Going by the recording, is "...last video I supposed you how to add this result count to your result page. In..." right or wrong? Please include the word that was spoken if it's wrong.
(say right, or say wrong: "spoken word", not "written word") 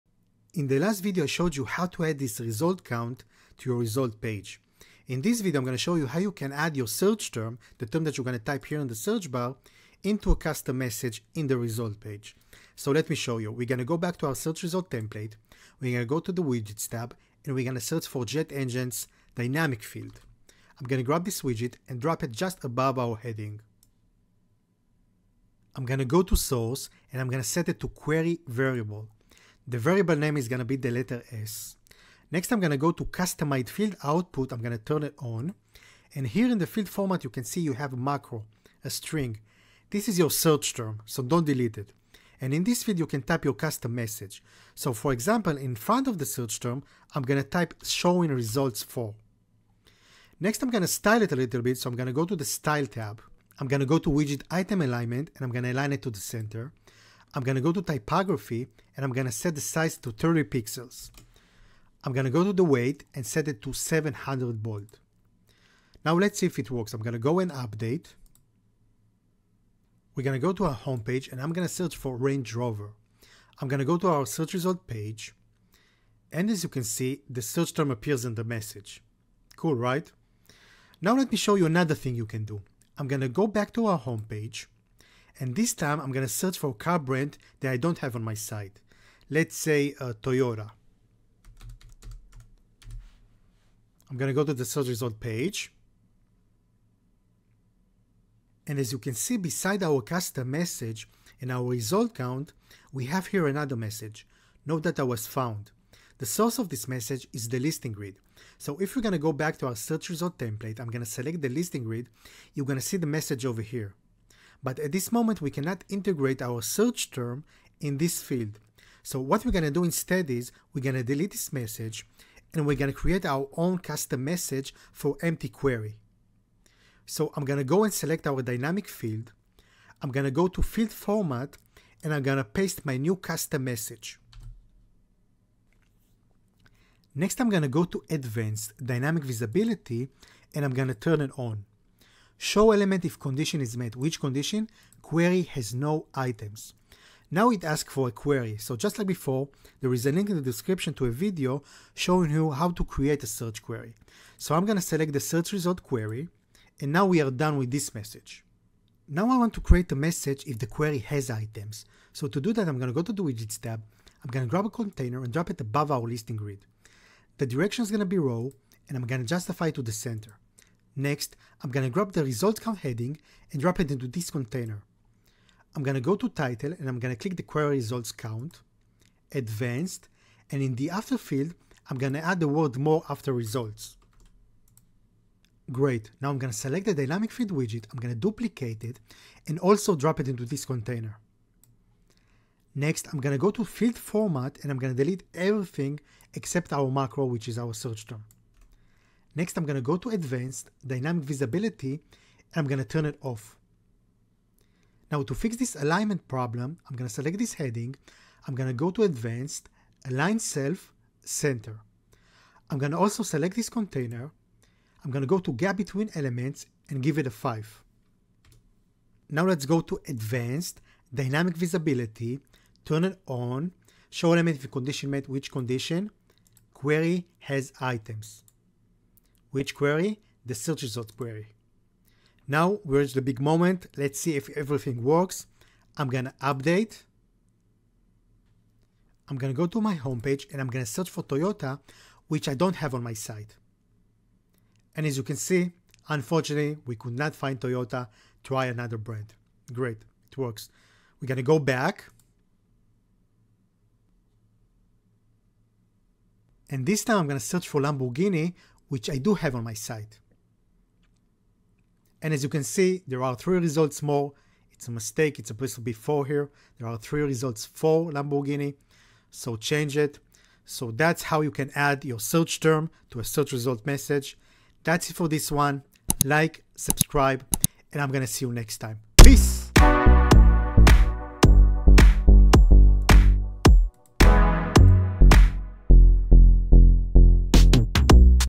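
wrong: "showed", not "supposed".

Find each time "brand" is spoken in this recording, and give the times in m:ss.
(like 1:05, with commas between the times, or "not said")
1:26, 4:08.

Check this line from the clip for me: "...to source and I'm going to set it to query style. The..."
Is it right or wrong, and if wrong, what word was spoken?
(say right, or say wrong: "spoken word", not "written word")
wrong: "variable", not "style".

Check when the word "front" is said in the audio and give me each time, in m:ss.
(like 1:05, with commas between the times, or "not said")
0:45.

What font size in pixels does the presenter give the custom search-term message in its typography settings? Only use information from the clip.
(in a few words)
30 pixels.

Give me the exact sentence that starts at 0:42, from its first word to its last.
And in this field, you can type your custom message.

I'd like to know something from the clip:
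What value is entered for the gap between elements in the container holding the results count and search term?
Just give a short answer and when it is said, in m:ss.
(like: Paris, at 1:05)
5, at 3:37.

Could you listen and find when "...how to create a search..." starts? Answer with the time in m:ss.
2:32.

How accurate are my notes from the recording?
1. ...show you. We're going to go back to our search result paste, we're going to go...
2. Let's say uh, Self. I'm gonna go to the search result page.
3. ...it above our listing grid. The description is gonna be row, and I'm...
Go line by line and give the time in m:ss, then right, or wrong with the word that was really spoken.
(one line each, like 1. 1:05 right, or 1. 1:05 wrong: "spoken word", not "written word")
1. 0:13 wrong: "template", not "paste"
2. 1:29 wrong: "Toyota", not "Self"
3. 2:45 wrong: "direction", not "description".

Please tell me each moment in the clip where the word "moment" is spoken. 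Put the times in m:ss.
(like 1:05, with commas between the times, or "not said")
1:55, 3:53.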